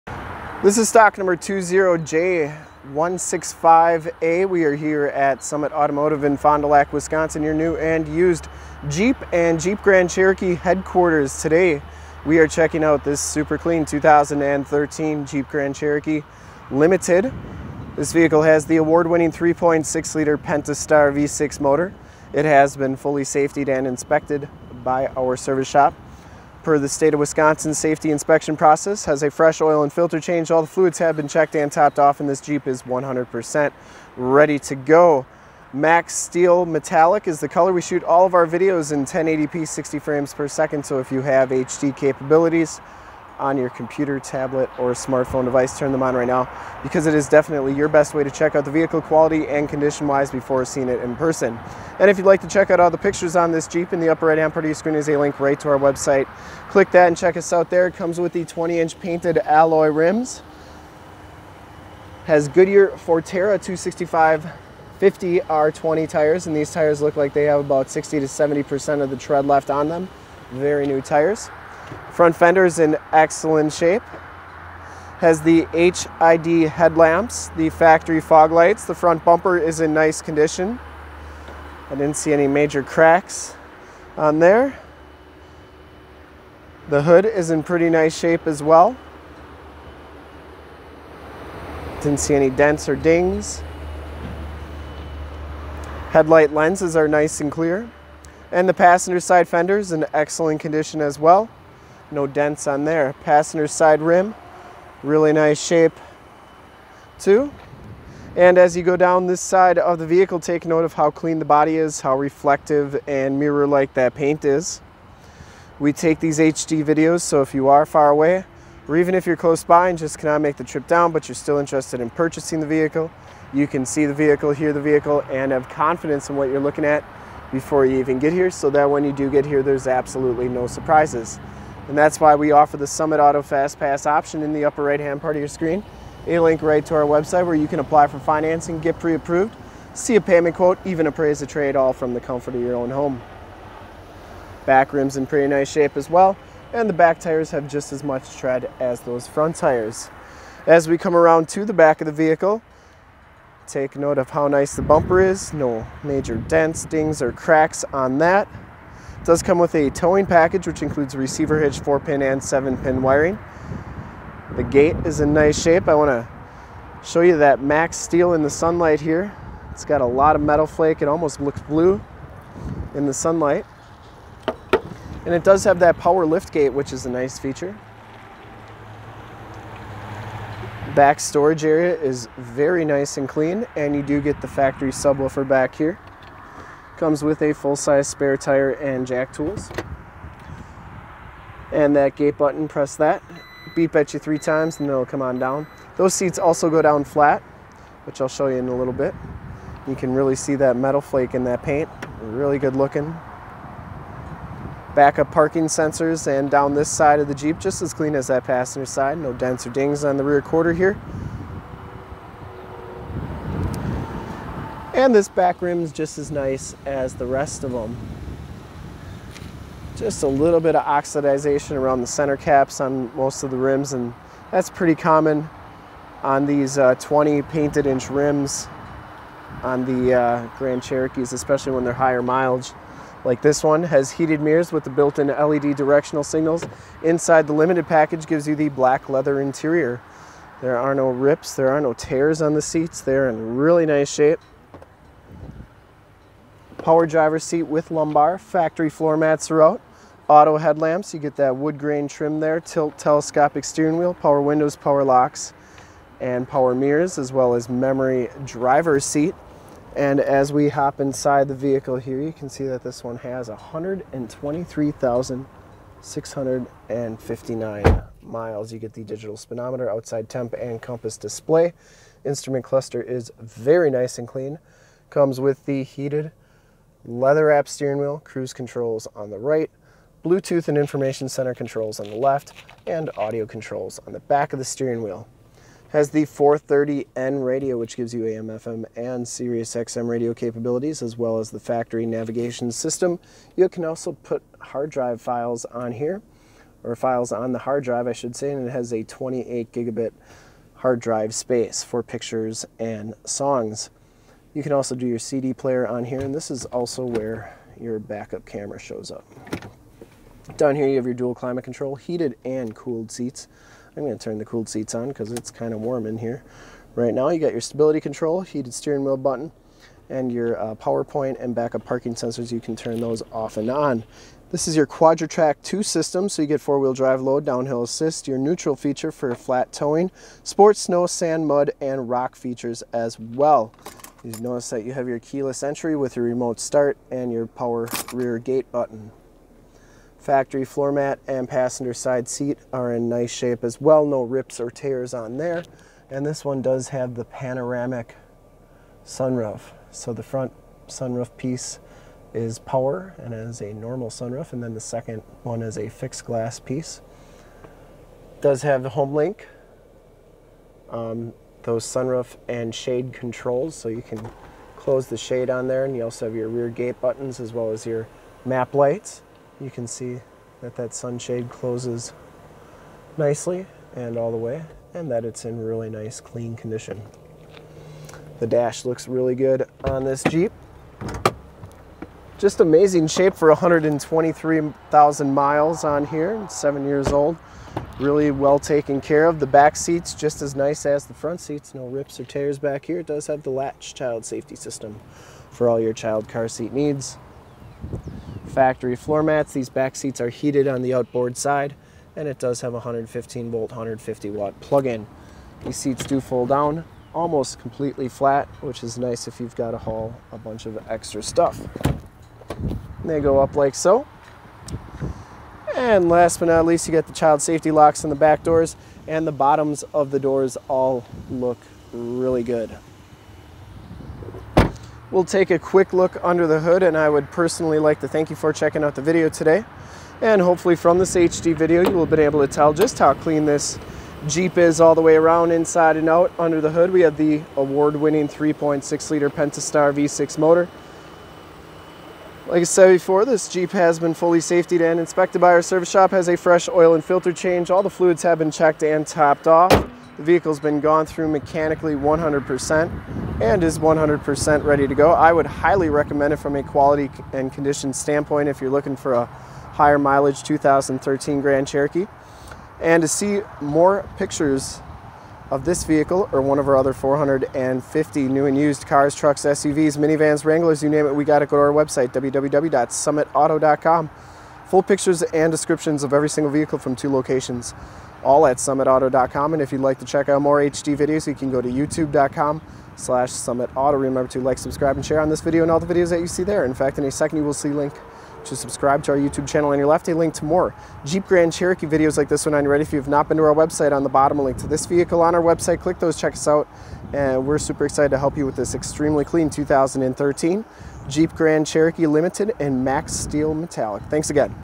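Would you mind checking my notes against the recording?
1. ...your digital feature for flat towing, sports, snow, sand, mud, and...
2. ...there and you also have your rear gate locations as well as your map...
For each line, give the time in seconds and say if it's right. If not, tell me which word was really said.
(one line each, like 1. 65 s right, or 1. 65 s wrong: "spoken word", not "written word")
1. 328 s wrong: "neutral", not "digital"
2. 365 s wrong: "buttons", not "locations".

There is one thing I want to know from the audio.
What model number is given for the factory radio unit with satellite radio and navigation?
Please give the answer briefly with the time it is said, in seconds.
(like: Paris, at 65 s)
430N, at 286 s.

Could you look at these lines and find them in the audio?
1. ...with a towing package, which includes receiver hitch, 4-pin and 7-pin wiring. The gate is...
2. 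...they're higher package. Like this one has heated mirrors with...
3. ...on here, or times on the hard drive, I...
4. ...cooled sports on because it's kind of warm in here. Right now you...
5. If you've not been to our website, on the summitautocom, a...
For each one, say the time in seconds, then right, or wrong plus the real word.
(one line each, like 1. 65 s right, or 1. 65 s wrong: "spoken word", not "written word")
1. 159 s right
2. 231 s wrong: "mileage", not "package"
3. 295 s wrong: "files", not "times"
4. 314 s wrong: "seats", not "sports"
5. 492 s wrong: "bottom", not "summitautocom".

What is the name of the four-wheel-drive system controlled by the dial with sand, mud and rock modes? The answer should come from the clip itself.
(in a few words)
Quadra-Trac 2.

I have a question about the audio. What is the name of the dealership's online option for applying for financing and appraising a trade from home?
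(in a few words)
Summit Auto Fast Pass.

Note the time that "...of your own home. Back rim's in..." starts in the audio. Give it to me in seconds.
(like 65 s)
142 s.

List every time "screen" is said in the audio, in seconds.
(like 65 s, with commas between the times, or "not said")
54 s, 135 s.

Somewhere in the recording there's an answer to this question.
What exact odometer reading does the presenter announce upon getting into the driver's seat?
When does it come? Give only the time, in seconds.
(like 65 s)
263 s.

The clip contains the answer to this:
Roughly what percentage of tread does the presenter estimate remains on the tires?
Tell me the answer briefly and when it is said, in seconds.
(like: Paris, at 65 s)
60 to 70%, at 67 s.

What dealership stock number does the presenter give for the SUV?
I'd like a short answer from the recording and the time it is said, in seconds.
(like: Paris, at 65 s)
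20J165A, at 1 s.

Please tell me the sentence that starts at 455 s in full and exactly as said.
I would highly recommend it from a quality and condition standpoint if you're looking for a higher mileage 2013 Grand Cherokee.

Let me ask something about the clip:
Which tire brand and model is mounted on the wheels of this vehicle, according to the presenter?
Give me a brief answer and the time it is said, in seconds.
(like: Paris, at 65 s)
Goodyear Fortera, at 62 s.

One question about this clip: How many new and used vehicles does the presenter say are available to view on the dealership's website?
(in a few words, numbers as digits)
450.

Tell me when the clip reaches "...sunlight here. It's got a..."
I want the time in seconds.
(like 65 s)
168 s.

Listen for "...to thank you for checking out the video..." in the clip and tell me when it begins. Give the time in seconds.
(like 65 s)
428 s.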